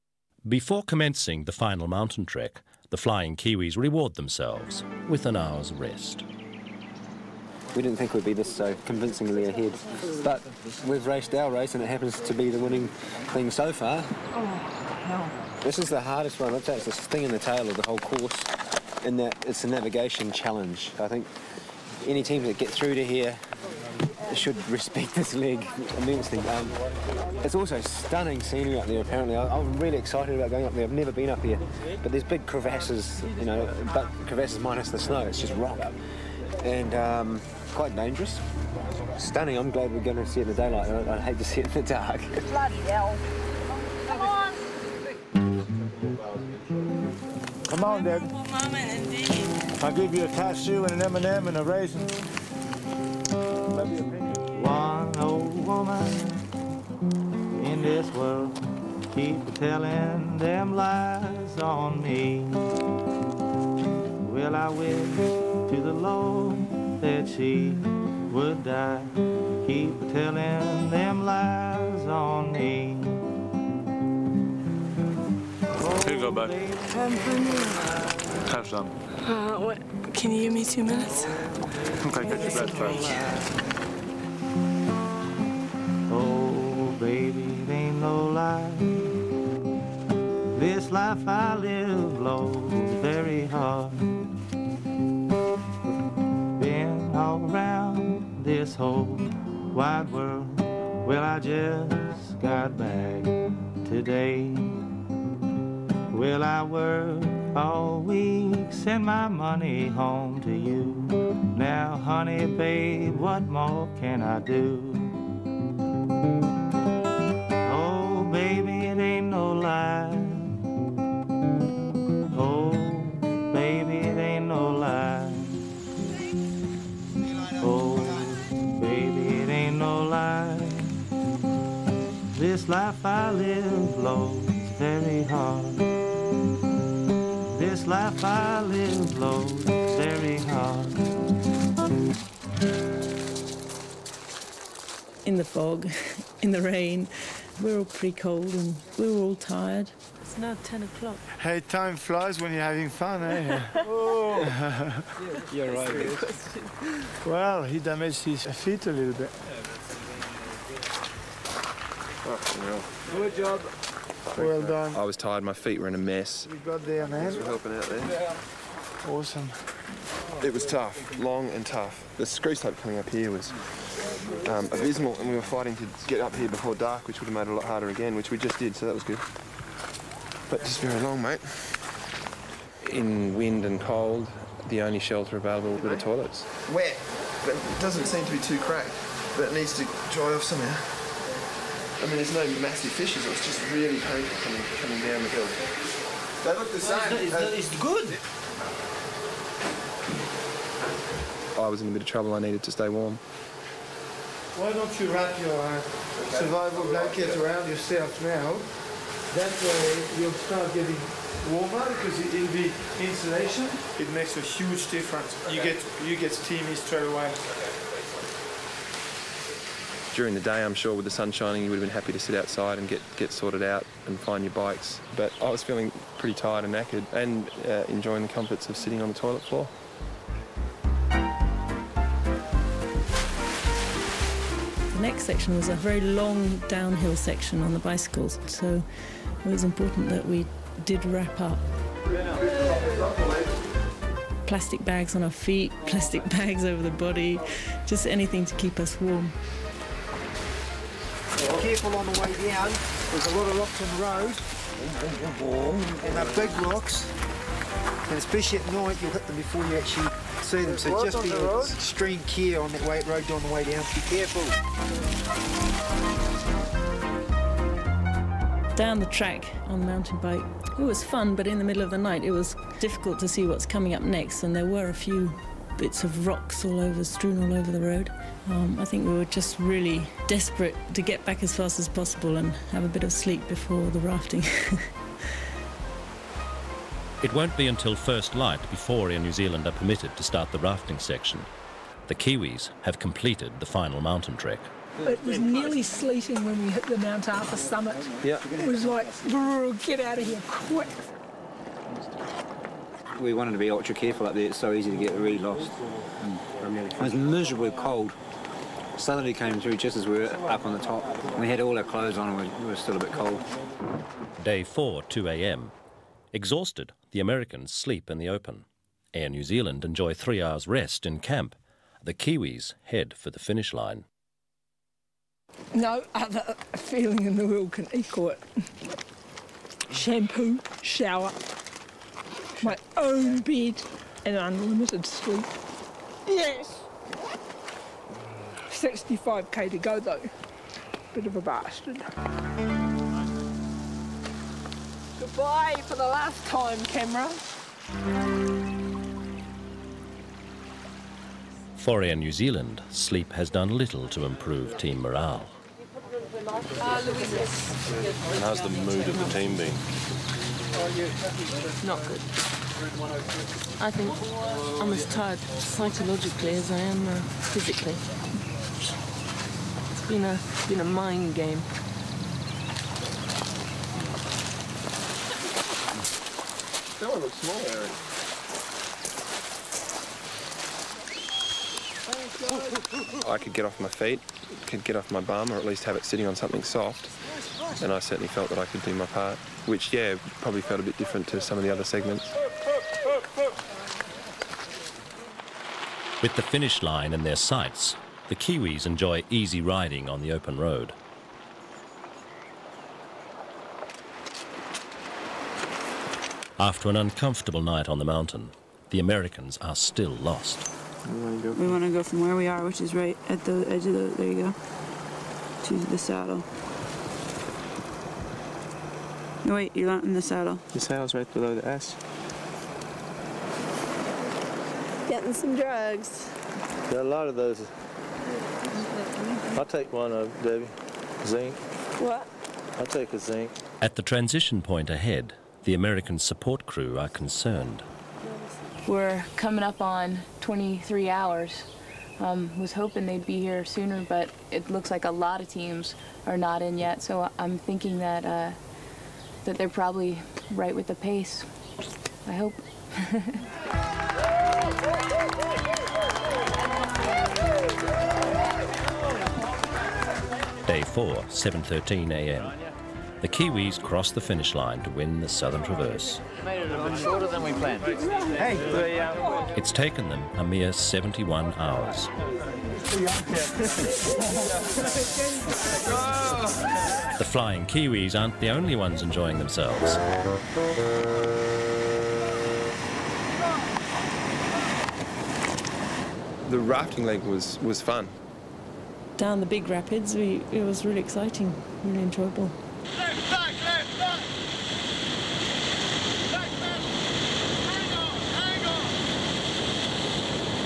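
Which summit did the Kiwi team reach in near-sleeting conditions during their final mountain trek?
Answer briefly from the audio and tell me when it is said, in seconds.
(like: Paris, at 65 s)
Mount Arthur, at 296 s.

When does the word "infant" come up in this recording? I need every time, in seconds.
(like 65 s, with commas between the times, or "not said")
not said.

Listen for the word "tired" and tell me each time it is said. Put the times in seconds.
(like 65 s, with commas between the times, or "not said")
149 s, 165 s, 226 s, 365 s.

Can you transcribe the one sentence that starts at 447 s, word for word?
So I'm thinking that uh, that they're probably right with the pace.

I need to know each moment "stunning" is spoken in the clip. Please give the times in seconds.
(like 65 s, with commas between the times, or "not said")
27 s, 39 s.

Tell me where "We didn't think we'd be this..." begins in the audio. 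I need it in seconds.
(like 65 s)
7 s.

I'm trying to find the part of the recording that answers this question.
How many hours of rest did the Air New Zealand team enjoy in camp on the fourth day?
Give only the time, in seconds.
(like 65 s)
320 s.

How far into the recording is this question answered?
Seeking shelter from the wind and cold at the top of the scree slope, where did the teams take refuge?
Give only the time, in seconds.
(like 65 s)
185 s.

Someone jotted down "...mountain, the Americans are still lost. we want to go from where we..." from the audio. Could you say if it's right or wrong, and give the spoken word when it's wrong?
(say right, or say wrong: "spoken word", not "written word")
right.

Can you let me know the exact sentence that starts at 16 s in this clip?
i it's the sting in the tail of the whole course in that it's a navigation challenge.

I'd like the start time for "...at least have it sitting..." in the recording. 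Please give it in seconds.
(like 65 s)
385 s.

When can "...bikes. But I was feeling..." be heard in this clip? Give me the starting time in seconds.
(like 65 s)
224 s.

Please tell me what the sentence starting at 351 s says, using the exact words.
For Air New Zealand, sleep has done little to improve team morale.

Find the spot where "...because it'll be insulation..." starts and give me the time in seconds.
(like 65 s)
211 s.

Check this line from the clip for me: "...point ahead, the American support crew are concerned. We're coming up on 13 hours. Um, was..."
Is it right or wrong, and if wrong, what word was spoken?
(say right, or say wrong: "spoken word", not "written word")
wrong: "23", not "13".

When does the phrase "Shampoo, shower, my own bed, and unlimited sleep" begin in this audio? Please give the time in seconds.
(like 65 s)
329 s.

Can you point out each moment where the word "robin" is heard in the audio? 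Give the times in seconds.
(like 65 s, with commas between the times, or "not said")
not said.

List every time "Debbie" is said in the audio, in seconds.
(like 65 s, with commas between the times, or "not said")
48 s, 430 s.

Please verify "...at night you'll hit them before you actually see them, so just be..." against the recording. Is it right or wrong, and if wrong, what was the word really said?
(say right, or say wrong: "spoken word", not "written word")
right.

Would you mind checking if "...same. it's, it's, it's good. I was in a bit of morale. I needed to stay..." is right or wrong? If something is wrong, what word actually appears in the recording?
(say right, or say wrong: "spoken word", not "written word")
wrong: "trouble", not "morale".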